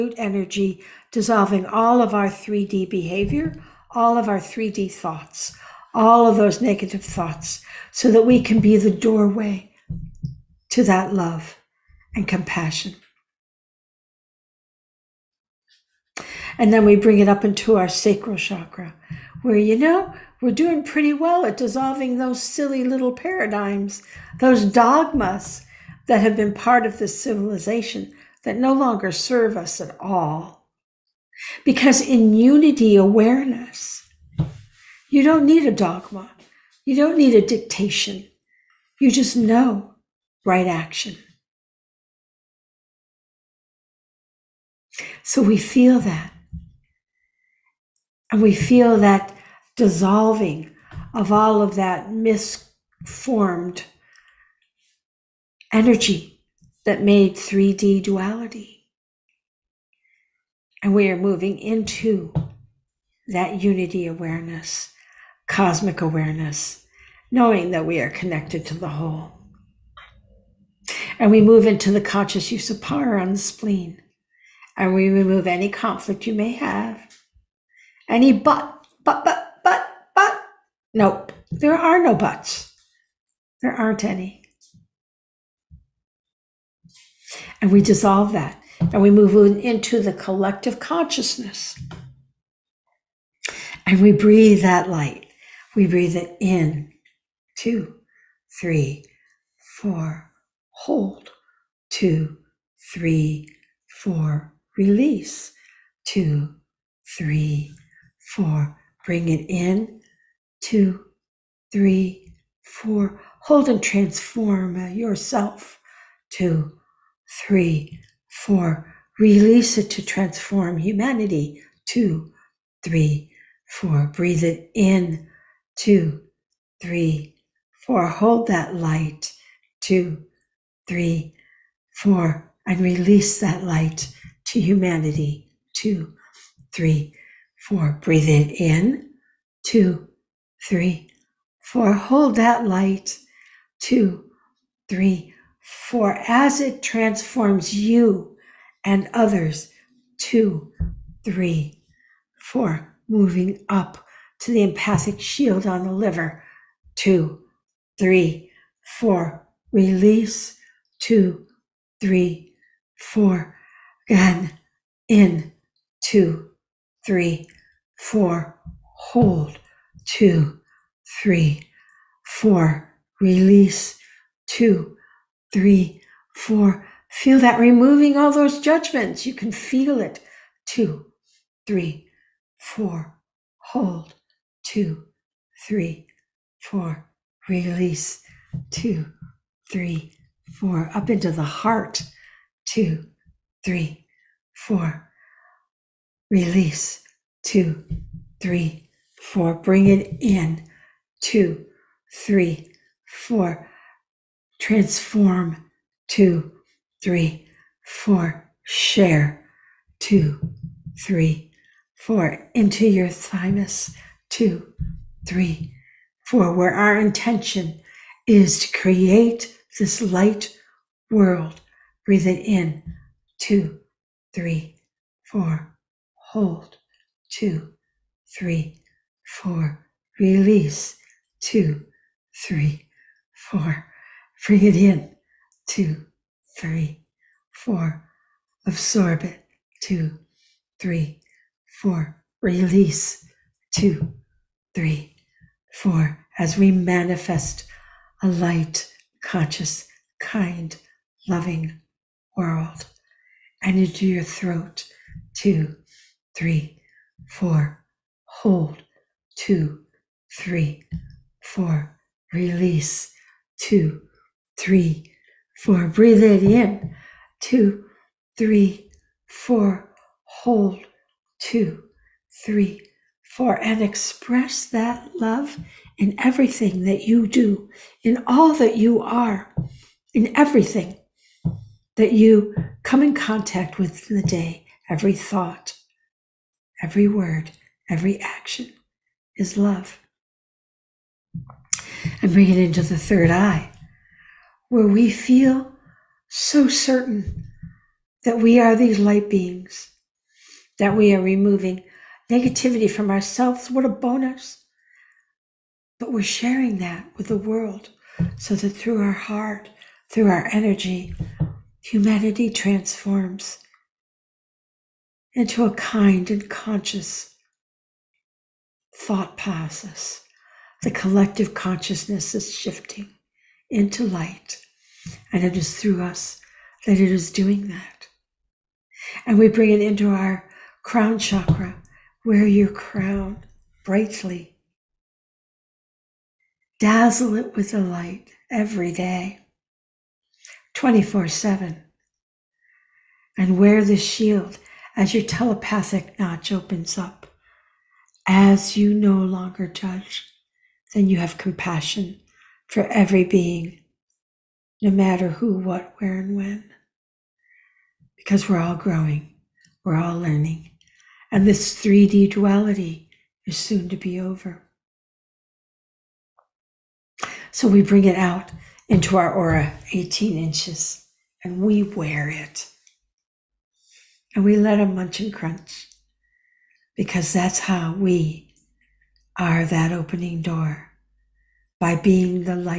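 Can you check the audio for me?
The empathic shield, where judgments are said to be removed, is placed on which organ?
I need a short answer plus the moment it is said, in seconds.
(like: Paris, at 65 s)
liver, at 155 s.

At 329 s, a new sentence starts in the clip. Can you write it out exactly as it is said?
And we bring it into our crown chakra, where your crown brightly.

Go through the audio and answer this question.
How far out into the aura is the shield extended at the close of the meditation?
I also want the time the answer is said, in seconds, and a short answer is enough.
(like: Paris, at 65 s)
18 inches, at 369 s.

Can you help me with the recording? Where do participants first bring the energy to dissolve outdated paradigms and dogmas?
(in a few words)
sacral chakra.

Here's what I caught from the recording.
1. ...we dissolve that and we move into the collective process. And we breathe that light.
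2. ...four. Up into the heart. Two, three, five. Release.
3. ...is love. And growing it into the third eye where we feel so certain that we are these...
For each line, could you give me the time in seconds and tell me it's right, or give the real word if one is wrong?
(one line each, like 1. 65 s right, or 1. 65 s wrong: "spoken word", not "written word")
1. 87 s wrong: "consciousness", not "process"
2. 190 s wrong: "four", not "five"
3. 289 s wrong: "bring", not "growing".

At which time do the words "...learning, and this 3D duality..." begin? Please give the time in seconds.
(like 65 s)
360 s.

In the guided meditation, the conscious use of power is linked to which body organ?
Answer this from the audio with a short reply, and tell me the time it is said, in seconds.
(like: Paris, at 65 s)
spleen, at 73 s.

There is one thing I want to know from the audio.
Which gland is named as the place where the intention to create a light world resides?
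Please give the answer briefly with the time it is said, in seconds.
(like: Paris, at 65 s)
thymus, at 213 s.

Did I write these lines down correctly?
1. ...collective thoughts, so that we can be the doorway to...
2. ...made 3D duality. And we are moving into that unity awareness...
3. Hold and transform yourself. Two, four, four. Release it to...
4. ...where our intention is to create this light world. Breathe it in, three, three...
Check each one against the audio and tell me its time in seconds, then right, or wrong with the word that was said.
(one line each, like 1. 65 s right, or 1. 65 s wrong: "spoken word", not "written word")
1. 6 s wrong: "negative", not "collective"
2. 57 s right
3. 113 s wrong: "three", not "four"
4. 216 s wrong: "two", not "three".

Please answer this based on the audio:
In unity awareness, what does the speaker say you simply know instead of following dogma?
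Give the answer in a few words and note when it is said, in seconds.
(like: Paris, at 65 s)
right action, at 40 s.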